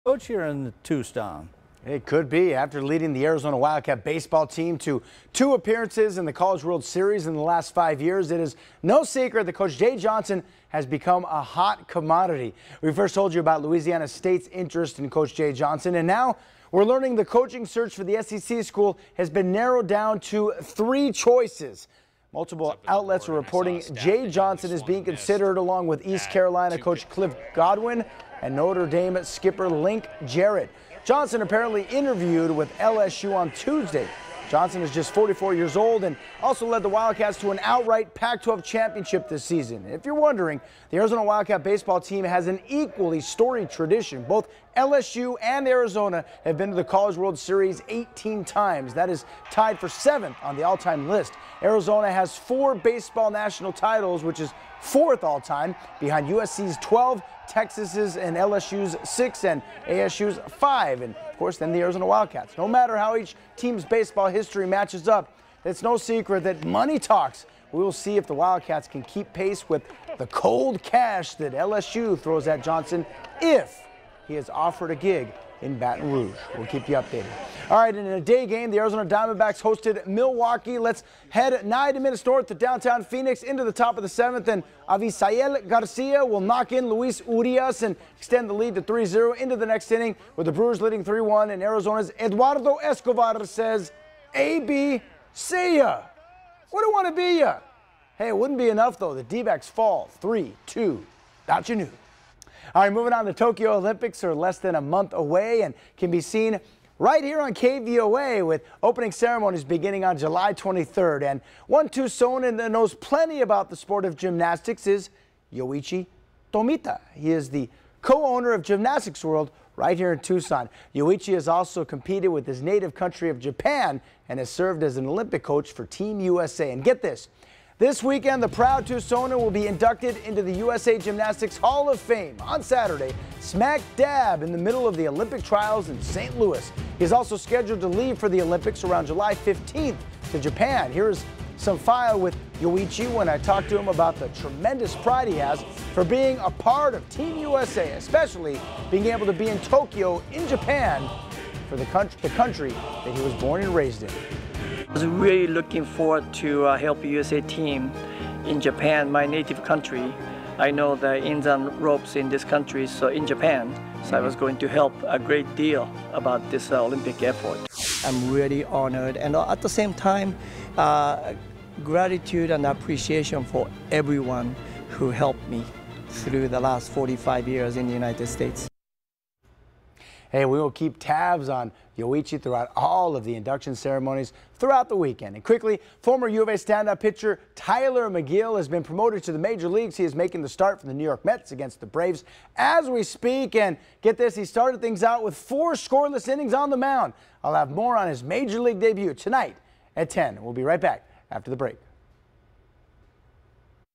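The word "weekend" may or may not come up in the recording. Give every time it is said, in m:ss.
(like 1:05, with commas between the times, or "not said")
2:08, 3:04.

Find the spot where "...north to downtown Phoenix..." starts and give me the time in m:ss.
1:22.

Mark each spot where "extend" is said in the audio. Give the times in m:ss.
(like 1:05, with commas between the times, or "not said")
1:28.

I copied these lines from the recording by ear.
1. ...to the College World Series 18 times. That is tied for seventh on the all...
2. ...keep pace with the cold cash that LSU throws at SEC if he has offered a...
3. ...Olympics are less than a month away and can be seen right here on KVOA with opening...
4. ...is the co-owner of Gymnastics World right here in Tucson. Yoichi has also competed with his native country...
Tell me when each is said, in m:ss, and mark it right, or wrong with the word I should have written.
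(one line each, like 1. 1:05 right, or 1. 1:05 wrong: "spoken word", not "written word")
1. 0:46 right
2. 1:09 wrong: "Johnson", not "SEC"
3. 1:43 right
4. 1:57 right.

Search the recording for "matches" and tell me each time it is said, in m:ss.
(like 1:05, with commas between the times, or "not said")
1:04.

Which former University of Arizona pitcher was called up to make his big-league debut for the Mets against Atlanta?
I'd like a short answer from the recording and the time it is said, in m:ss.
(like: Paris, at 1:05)
Tylor Megill, at 3:07.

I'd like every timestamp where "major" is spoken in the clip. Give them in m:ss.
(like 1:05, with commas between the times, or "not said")
3:09, 3:18.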